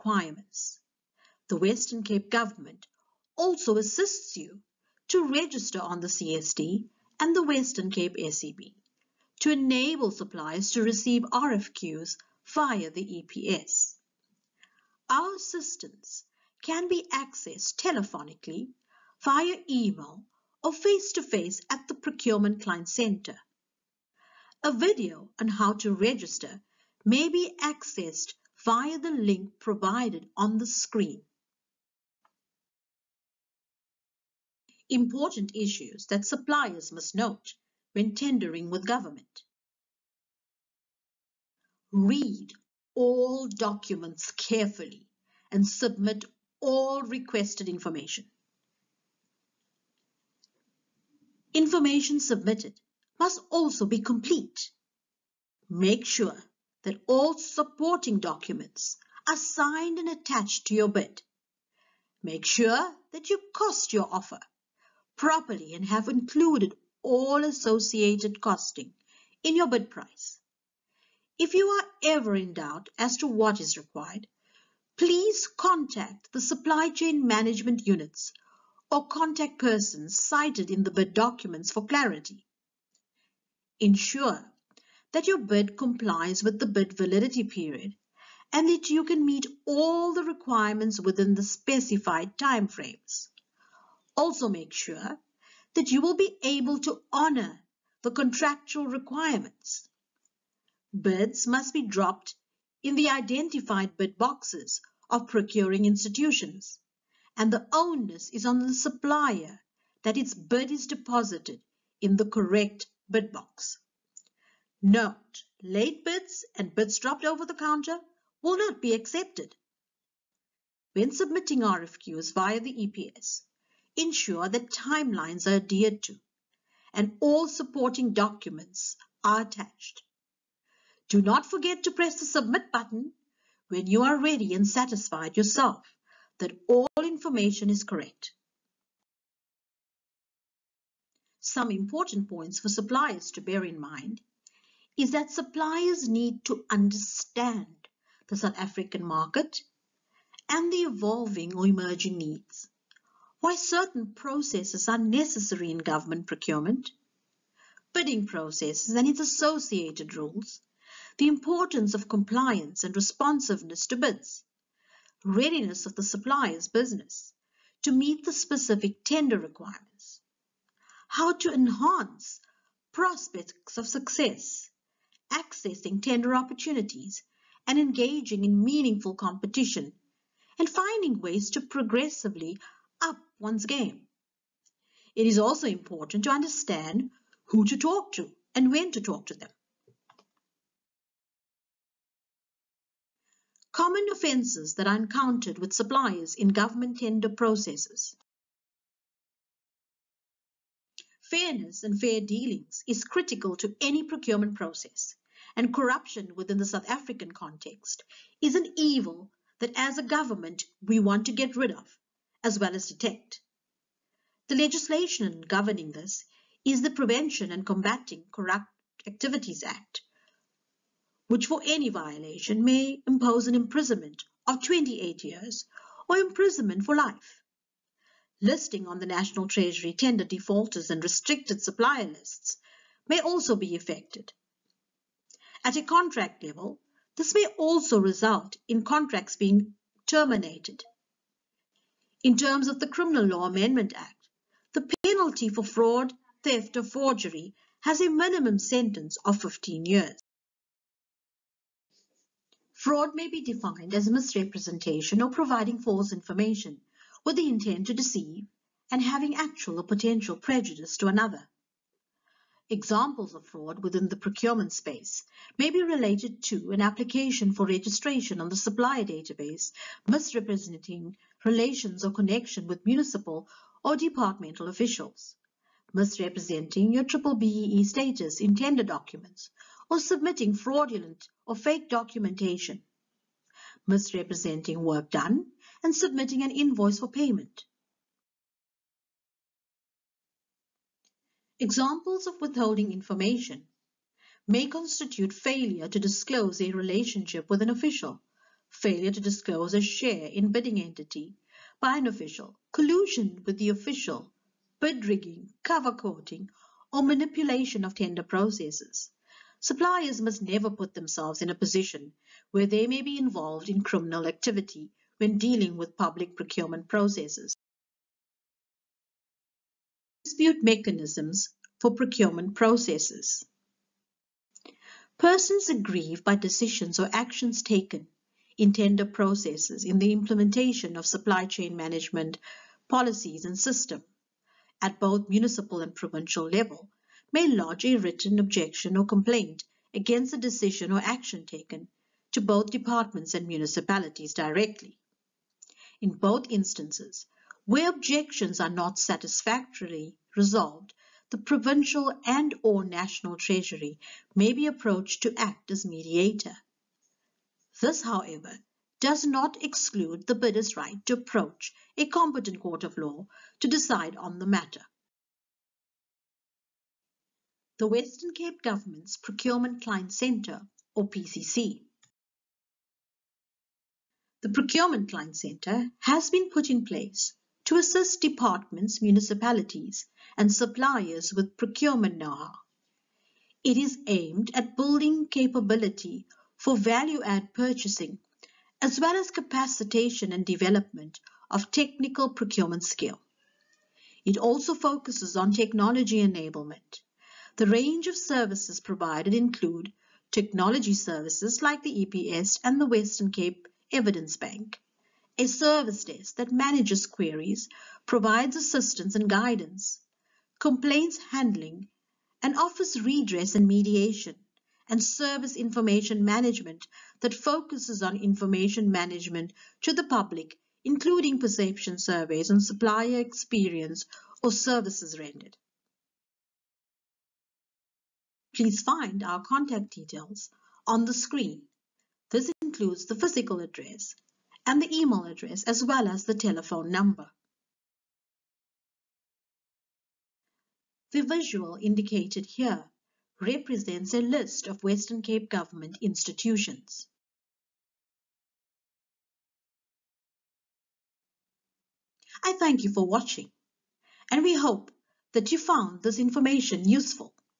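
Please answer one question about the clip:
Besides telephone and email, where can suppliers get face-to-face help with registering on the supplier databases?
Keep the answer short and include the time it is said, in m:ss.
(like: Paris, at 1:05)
Procurement Client Center, at 0:21.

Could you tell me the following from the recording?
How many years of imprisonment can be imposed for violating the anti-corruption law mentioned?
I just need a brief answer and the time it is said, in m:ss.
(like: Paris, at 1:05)
28 years, at 3:44.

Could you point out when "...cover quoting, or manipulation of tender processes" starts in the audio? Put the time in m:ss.
5:05.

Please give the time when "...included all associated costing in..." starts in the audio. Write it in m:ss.
1:06.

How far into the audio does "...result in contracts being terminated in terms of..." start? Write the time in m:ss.
3:57.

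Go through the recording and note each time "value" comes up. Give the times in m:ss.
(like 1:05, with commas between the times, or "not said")
6:26.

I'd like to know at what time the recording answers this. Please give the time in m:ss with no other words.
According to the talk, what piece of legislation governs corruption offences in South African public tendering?
3:36.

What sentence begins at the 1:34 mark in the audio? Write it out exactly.
Also make sure that you will be able to honor the contractual requirements.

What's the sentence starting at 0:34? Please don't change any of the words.
important issues that suppliers must note when tendering with government.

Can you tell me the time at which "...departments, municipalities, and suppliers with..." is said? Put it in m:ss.
6:18.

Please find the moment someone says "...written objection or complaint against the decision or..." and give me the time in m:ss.
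5:37.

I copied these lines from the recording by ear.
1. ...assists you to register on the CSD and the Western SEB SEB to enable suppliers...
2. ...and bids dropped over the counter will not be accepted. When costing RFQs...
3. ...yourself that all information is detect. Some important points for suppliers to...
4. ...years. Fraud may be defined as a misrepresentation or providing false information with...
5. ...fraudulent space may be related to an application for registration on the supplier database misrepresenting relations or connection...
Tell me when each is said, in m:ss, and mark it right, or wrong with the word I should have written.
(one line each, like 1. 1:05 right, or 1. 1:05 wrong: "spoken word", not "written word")
1. 0:03 wrong: "Cape", not "SEB"
2. 1:56 wrong: "submitting", not "costing"
3. 2:15 wrong: "correct", not "detect"
4. 4:09 right
5. 4:24 wrong: "procurement", not "fraudulent".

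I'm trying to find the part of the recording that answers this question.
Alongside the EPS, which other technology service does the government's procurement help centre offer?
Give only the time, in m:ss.
6:42.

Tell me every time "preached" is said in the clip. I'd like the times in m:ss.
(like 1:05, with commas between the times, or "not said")
not said.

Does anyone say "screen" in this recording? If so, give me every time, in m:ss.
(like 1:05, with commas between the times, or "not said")
0:30, 7:11.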